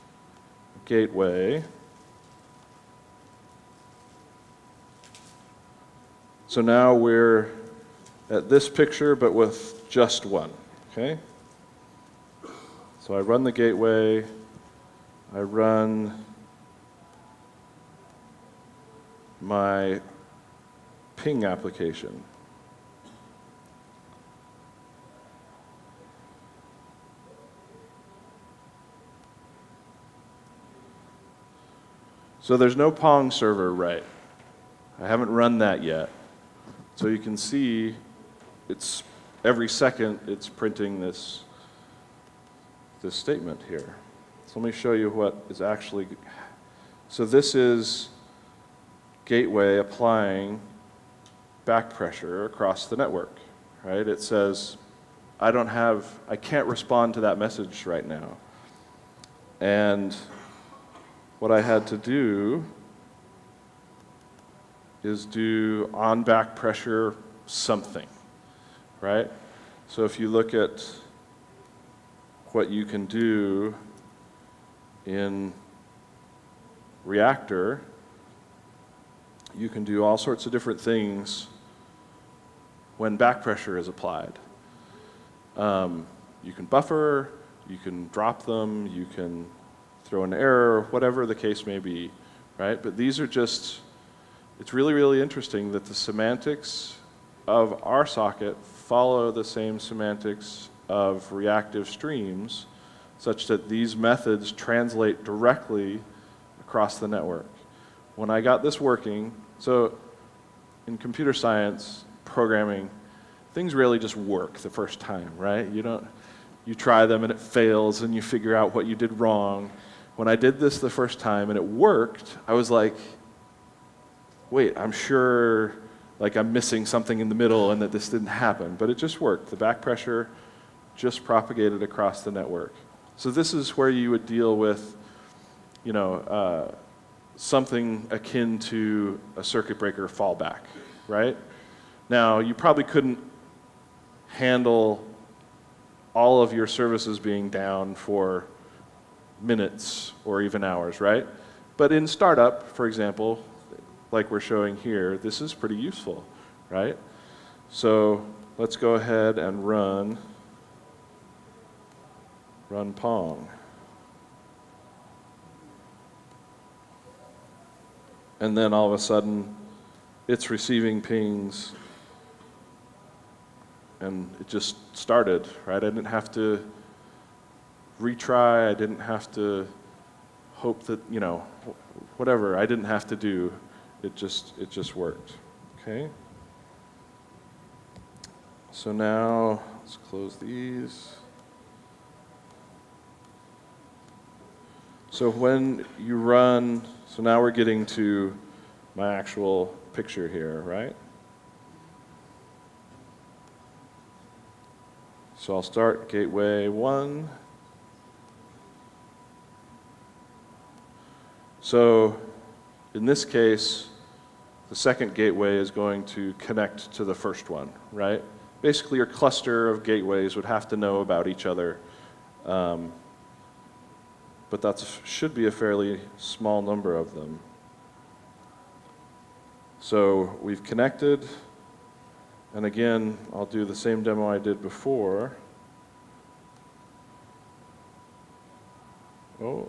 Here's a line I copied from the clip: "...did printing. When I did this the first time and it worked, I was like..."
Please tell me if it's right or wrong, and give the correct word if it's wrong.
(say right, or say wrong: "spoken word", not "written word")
wrong: "wrong", not "printing".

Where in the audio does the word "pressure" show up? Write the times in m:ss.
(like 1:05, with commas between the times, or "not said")
0:51, 1:06, 1:23, 2:09.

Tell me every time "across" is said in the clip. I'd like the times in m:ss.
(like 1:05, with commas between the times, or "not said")
0:52, 1:46, 2:11.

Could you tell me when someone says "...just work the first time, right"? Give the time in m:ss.
1:53.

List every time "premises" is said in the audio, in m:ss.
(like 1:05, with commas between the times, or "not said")
not said.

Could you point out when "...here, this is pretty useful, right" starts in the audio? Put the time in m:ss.
2:34.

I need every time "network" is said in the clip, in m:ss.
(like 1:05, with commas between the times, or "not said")
0:52, 1:47, 2:12.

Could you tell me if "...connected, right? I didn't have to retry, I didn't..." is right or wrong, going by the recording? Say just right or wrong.
wrong.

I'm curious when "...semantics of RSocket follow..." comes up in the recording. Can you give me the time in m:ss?
1:35.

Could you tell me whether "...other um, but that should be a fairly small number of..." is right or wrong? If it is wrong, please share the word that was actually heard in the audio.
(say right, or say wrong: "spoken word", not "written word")
right.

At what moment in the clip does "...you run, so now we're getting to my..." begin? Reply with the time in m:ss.
3:15.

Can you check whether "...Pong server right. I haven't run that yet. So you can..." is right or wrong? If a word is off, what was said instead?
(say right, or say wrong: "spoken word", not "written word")
right.